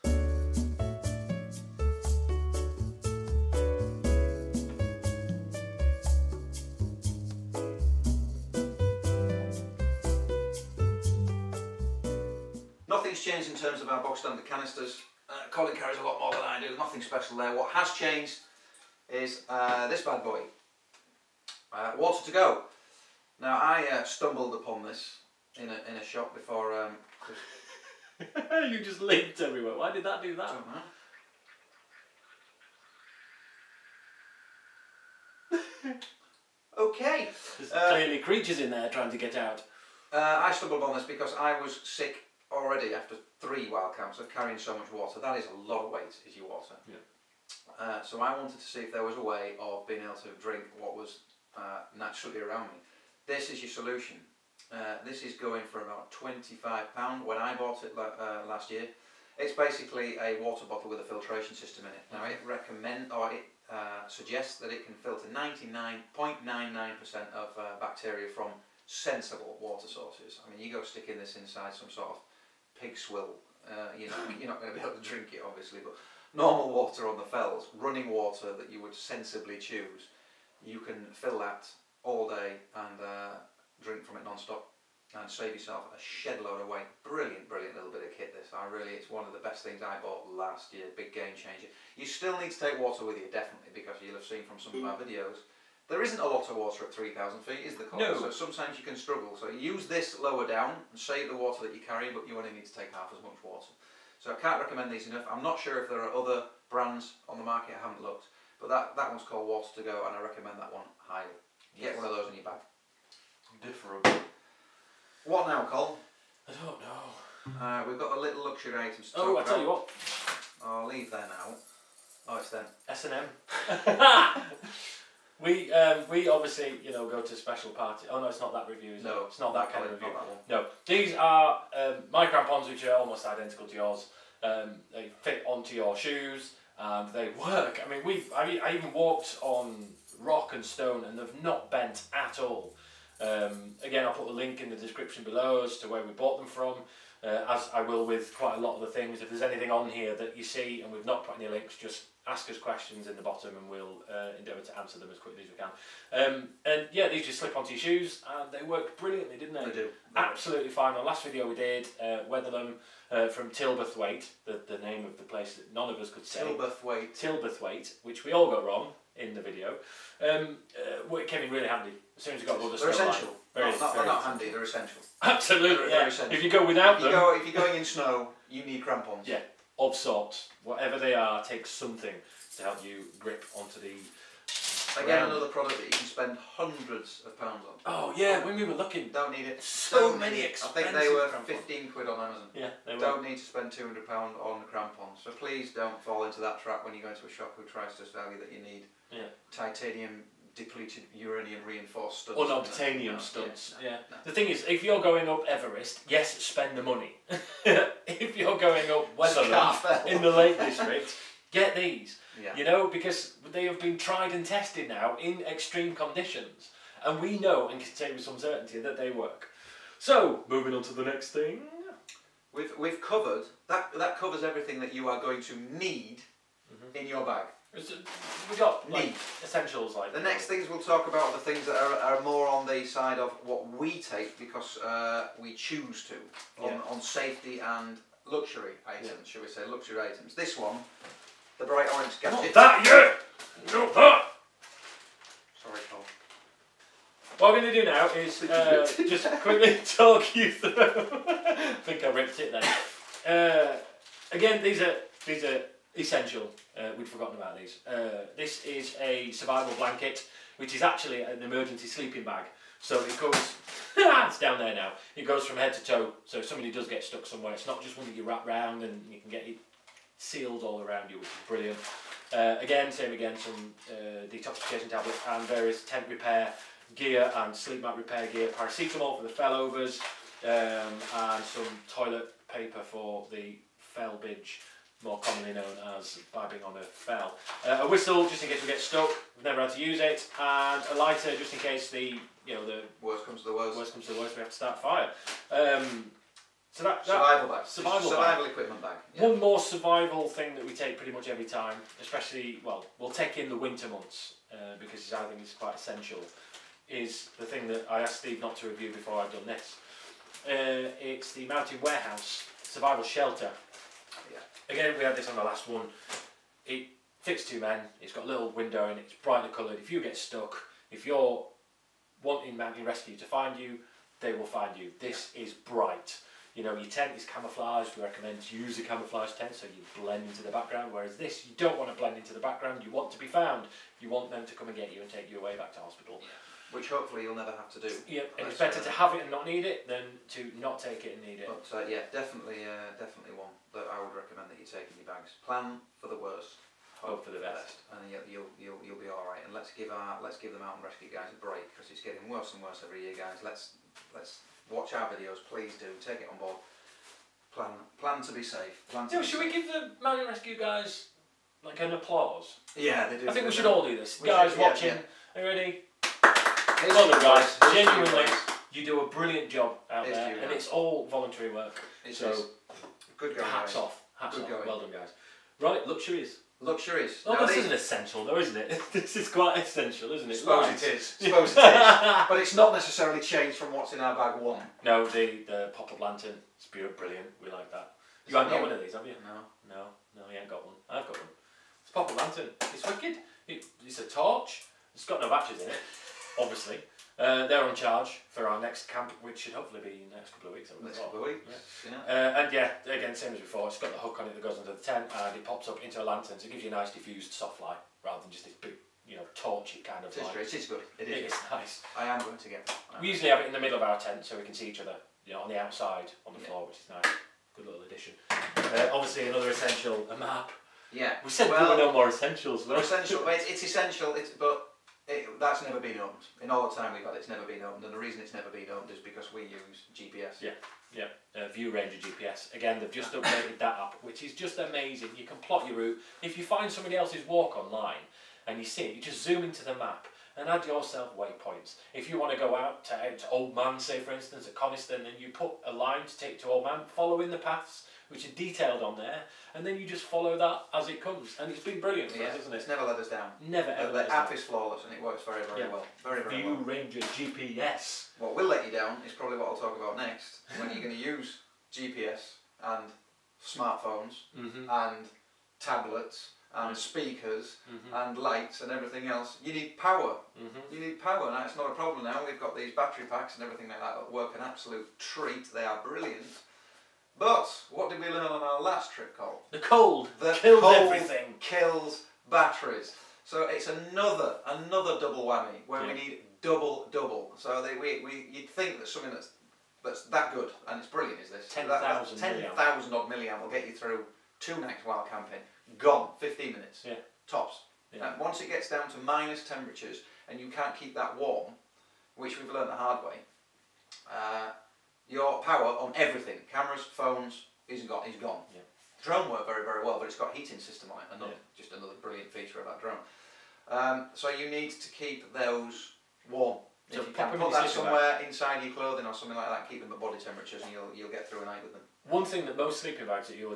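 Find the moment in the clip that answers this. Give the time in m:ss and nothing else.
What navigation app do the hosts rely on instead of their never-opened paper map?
7:11.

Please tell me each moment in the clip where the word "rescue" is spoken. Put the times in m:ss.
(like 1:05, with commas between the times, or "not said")
5:22, 5:50, 6:00.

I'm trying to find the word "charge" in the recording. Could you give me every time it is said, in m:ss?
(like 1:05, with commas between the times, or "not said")
6:37.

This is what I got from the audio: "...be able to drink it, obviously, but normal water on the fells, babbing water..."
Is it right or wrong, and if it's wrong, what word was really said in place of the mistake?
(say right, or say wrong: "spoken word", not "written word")
wrong: "running", not "babbing".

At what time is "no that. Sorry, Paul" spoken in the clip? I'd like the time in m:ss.
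4:03.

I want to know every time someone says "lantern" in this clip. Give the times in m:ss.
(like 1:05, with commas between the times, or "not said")
6:26, 6:32, 6:46.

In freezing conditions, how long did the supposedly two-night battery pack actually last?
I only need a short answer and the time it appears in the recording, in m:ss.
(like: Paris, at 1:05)
15 minutes, at 8:16.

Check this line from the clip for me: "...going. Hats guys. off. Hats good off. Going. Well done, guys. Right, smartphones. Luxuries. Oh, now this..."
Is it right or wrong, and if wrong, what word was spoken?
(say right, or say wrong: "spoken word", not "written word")
wrong: "luxuries", not "smartphones".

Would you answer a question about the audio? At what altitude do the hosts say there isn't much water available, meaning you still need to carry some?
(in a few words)
3,000 feet.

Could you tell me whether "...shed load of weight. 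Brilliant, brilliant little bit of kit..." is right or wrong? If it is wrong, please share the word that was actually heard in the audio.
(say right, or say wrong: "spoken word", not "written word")
right.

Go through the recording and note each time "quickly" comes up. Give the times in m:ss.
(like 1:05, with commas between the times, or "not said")
2:35, 4:09.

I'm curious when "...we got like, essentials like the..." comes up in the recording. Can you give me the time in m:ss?
3:48.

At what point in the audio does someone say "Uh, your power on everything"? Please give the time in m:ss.
8:24.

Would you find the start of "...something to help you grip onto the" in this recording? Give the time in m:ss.
3:01.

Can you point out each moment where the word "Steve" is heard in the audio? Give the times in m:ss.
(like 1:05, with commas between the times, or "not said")
5:08.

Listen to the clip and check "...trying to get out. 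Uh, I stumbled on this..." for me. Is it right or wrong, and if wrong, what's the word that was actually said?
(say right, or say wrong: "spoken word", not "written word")
right.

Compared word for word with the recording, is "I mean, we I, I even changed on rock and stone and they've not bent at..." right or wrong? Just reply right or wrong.
wrong.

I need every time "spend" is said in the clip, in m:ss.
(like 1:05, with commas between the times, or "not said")
3:06, 3:13, 3:26.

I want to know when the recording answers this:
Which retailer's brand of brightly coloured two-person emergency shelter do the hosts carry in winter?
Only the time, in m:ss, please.
5:11.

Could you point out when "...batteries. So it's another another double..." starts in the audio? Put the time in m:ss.
8:02.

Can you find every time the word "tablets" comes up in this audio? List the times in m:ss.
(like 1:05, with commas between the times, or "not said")
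4:34, 7:45.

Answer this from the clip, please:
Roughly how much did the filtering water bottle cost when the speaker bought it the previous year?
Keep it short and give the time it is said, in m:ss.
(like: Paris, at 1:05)
£25, at 0:56.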